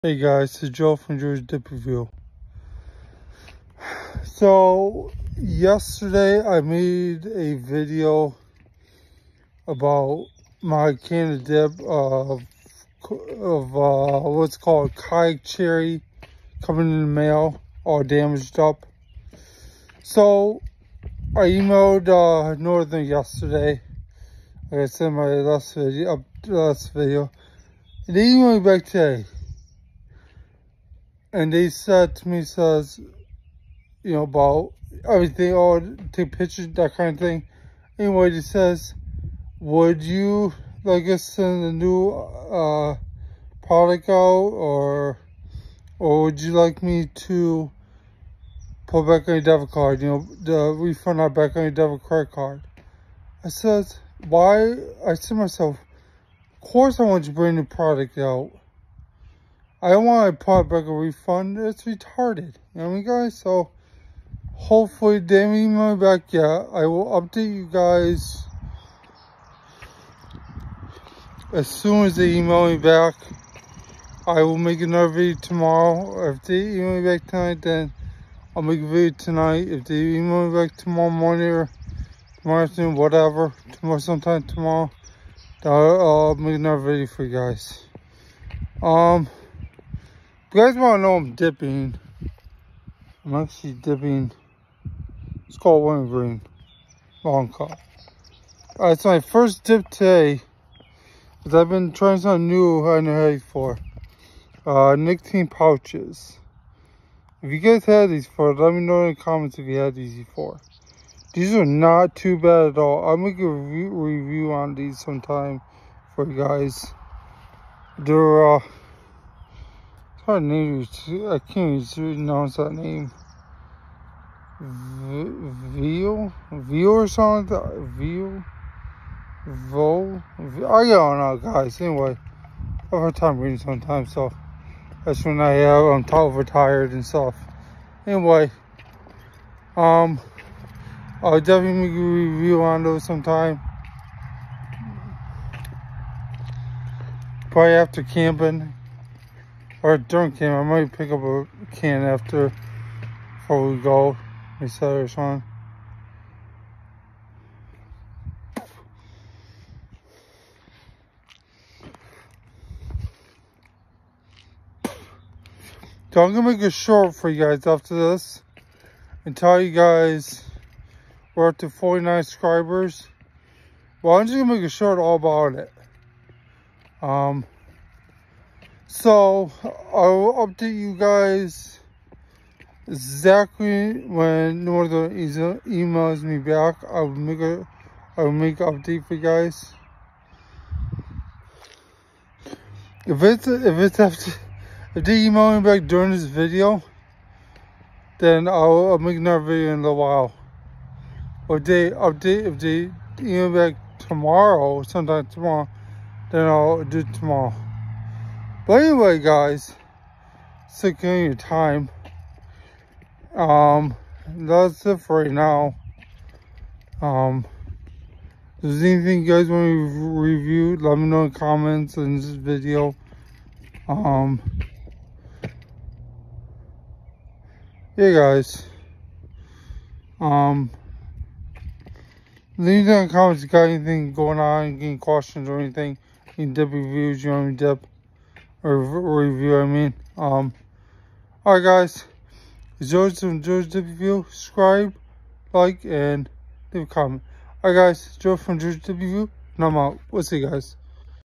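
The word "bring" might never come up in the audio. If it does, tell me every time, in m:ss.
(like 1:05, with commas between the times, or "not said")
0:57.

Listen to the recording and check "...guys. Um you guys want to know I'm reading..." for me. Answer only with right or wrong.
wrong.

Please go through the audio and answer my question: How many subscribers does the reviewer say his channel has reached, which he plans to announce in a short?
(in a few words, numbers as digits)
49.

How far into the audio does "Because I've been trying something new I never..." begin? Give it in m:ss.
1:41.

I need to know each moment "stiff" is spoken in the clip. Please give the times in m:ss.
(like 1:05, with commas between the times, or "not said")
not said.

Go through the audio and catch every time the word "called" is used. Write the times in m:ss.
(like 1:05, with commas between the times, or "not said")
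0:14, 1:35.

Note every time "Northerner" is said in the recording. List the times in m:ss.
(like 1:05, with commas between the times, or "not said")
0:22, 3:04.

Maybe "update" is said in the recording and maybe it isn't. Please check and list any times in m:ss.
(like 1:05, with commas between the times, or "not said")
1:07, 3:00, 3:08, 3:21.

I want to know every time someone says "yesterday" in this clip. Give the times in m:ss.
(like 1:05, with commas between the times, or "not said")
0:05, 0:23.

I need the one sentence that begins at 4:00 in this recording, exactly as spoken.
Um, Alright guys, George from George W.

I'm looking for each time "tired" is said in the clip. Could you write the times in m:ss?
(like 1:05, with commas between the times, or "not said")
2:16.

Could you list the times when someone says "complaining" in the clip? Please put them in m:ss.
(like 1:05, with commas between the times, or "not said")
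not said.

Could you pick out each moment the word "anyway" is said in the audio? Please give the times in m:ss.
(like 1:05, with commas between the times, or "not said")
0:37, 2:11, 2:18, 3:28.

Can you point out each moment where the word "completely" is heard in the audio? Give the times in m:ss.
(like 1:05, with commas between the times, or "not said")
not said.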